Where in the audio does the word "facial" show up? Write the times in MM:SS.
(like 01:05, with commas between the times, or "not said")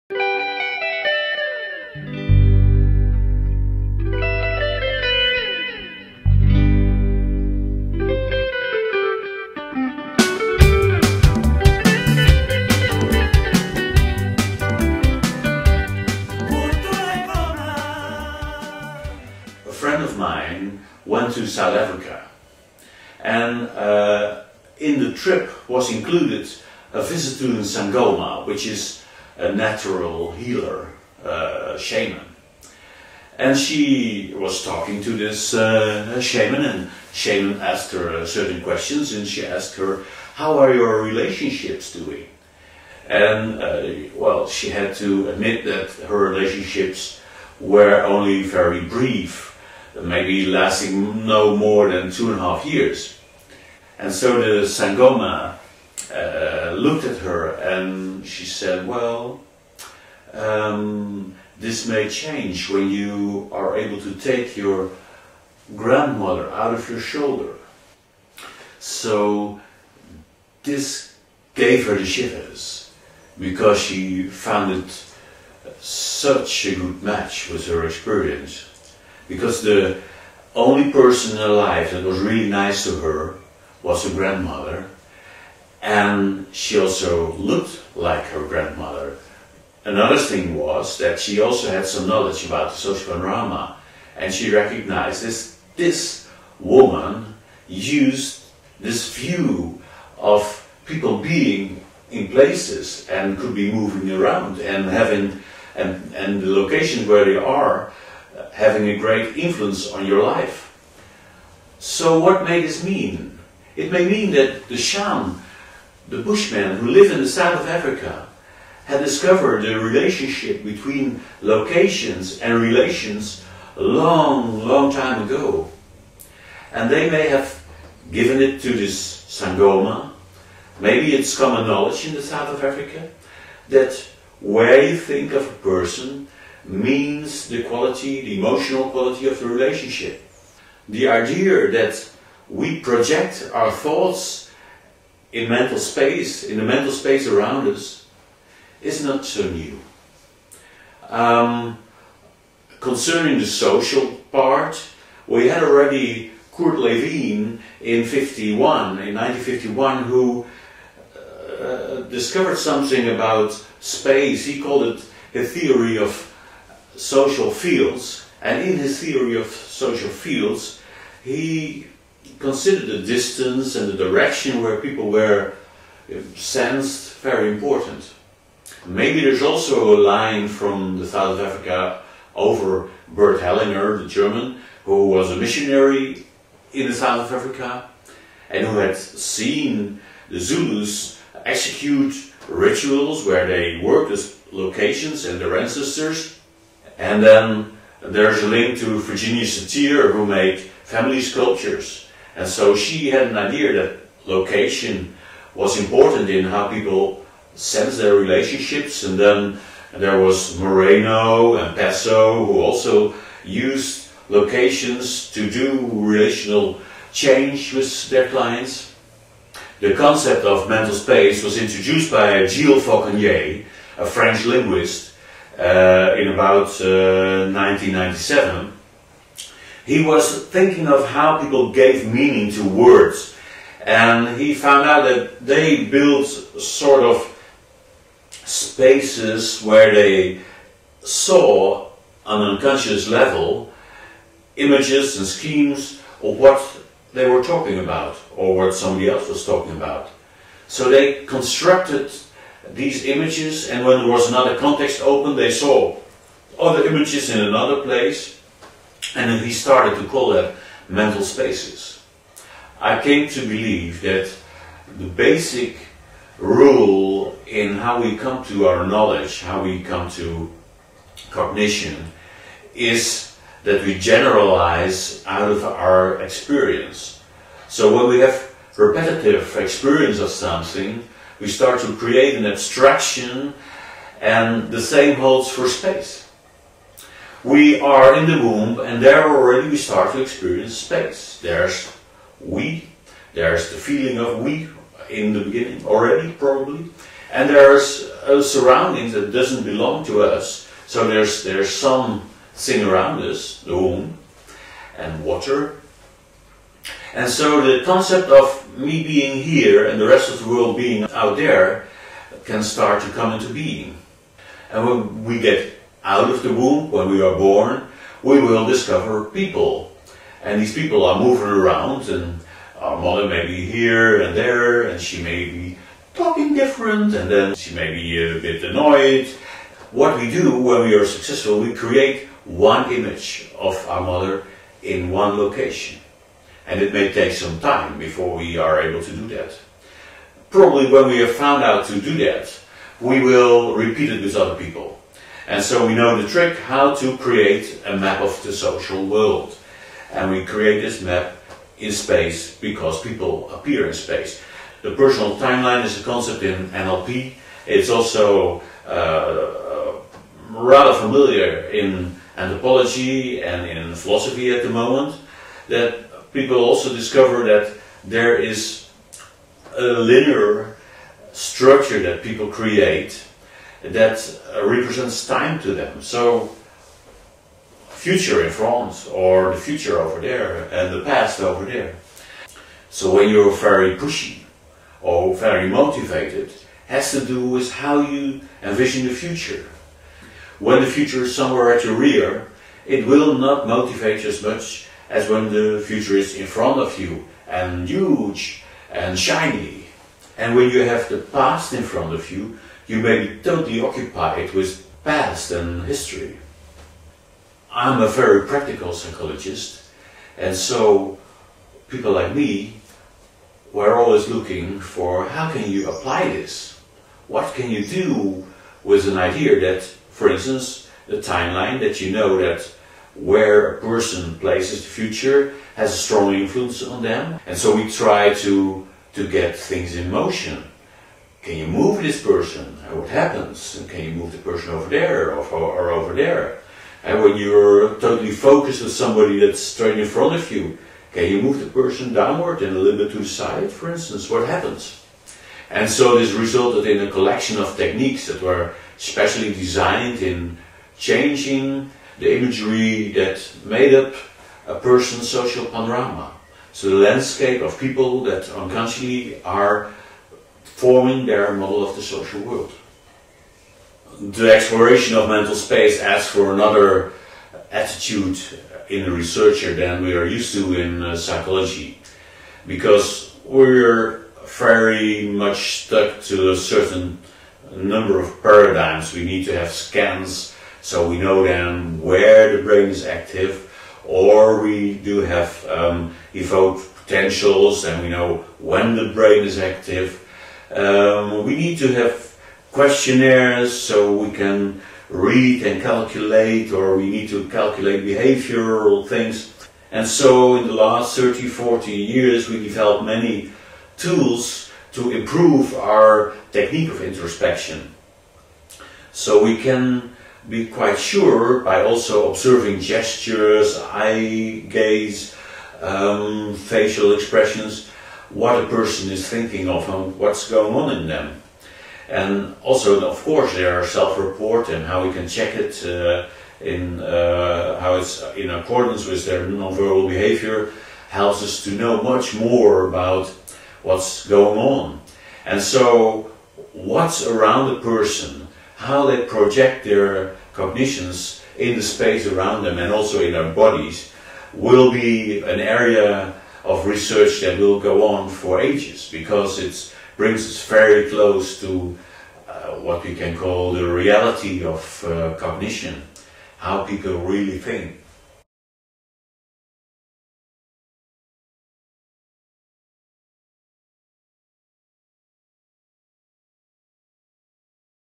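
08:36.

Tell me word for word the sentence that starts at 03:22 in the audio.
And so she had an idea that location was important in how people sense their relationships.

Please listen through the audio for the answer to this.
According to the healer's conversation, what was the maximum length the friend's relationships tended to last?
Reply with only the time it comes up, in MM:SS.
00:52.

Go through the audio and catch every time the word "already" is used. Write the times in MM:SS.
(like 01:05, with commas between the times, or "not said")
02:35, 04:49, 04:55.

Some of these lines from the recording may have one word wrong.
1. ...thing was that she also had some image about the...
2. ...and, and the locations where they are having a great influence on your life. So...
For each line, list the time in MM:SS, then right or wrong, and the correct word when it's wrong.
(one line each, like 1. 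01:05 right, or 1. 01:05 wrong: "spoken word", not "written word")
1. 01:30 wrong: "knowledge", not "image"
2. 01:45 right.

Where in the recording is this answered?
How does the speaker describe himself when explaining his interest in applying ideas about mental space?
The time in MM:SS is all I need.
06:48.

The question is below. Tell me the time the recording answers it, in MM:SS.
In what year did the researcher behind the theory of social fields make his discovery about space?
02:39.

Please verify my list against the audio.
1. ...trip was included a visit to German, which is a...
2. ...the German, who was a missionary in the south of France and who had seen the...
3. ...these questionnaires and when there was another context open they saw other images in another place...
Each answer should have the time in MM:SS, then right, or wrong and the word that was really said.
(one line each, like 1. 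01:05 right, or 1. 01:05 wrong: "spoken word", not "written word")
1. 00:25 wrong: "Sangoma", not "German"
2. 03:04 wrong: "Africa", not "France"
3. 04:12 wrong: "images", not "questionnaires".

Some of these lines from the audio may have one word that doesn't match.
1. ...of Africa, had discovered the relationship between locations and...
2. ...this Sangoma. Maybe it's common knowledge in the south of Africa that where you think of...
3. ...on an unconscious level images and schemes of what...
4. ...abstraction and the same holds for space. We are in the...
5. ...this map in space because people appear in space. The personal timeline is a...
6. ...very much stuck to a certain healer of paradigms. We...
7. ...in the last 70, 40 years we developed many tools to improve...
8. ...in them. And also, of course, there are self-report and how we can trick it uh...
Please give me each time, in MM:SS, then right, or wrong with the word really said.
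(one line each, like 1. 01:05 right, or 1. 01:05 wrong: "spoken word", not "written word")
1. 01:57 right
2. 02:08 right
3. 04:02 right
4. 04:42 right
5. 05:50 right
6. 07:54 wrong: "number", not "healer"
7. 08:20 wrong: "30", not "70"
8. 08:40 wrong: "check", not "trick".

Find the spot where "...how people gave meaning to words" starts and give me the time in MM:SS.
03:51.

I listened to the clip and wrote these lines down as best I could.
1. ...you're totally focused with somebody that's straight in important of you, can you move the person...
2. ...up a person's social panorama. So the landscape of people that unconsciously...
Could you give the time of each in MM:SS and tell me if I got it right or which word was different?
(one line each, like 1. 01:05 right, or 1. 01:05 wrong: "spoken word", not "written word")
1. 07:17 wrong: "front", not "important"
2. 07:33 right.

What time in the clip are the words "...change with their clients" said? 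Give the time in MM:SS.
03:37.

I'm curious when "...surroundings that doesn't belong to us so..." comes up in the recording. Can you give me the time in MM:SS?
04:58.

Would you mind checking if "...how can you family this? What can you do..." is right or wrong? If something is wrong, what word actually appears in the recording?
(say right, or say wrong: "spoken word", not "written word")
wrong: "apply", not "family".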